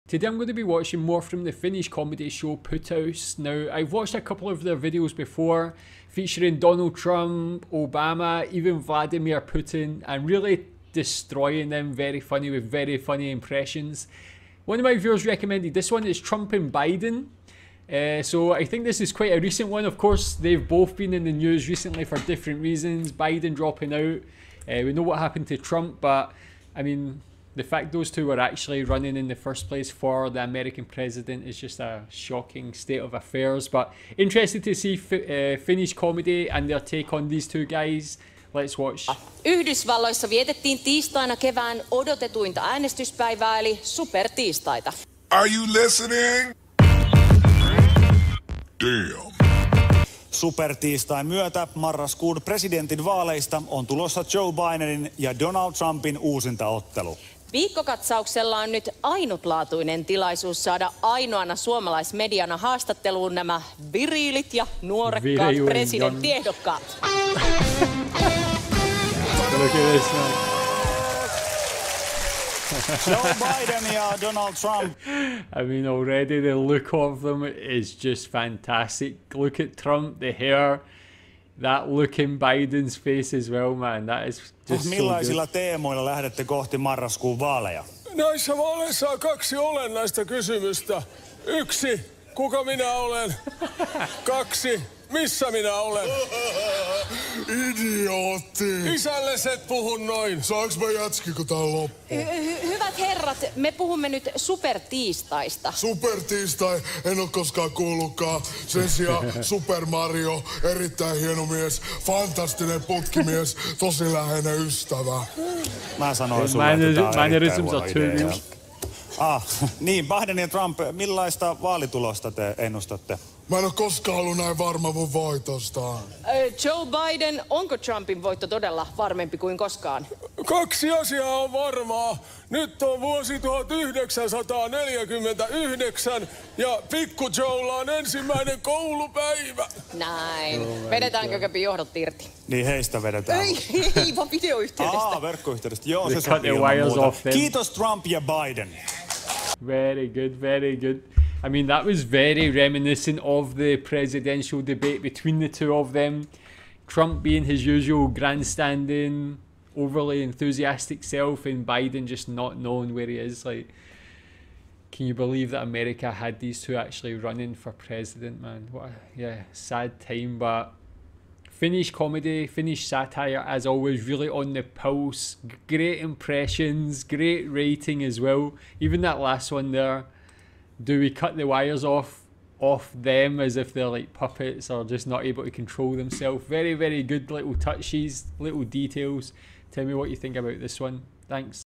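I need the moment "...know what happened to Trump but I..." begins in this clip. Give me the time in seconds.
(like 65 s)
24 s.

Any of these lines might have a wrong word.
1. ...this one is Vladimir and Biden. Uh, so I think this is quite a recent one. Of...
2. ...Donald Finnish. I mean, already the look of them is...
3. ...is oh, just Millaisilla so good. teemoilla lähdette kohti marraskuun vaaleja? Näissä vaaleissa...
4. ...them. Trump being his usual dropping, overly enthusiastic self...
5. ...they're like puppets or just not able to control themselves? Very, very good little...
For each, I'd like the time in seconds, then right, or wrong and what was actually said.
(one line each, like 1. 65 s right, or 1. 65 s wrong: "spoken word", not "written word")
1. 15 s wrong: "Trump", not "Vladimir"
2. 74 s wrong: "Trump", not "Finnish"
3. 84 s right
4. 155 s wrong: "grandstanding", not "dropping"
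5. 183 s right.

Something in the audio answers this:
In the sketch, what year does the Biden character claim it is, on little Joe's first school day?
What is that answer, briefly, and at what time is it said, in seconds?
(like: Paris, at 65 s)
1949, at 133 s.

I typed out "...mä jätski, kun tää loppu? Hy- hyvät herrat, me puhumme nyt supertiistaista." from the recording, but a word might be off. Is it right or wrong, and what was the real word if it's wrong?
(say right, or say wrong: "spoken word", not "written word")
right.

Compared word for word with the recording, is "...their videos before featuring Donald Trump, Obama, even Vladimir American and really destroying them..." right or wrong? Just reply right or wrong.
wrong.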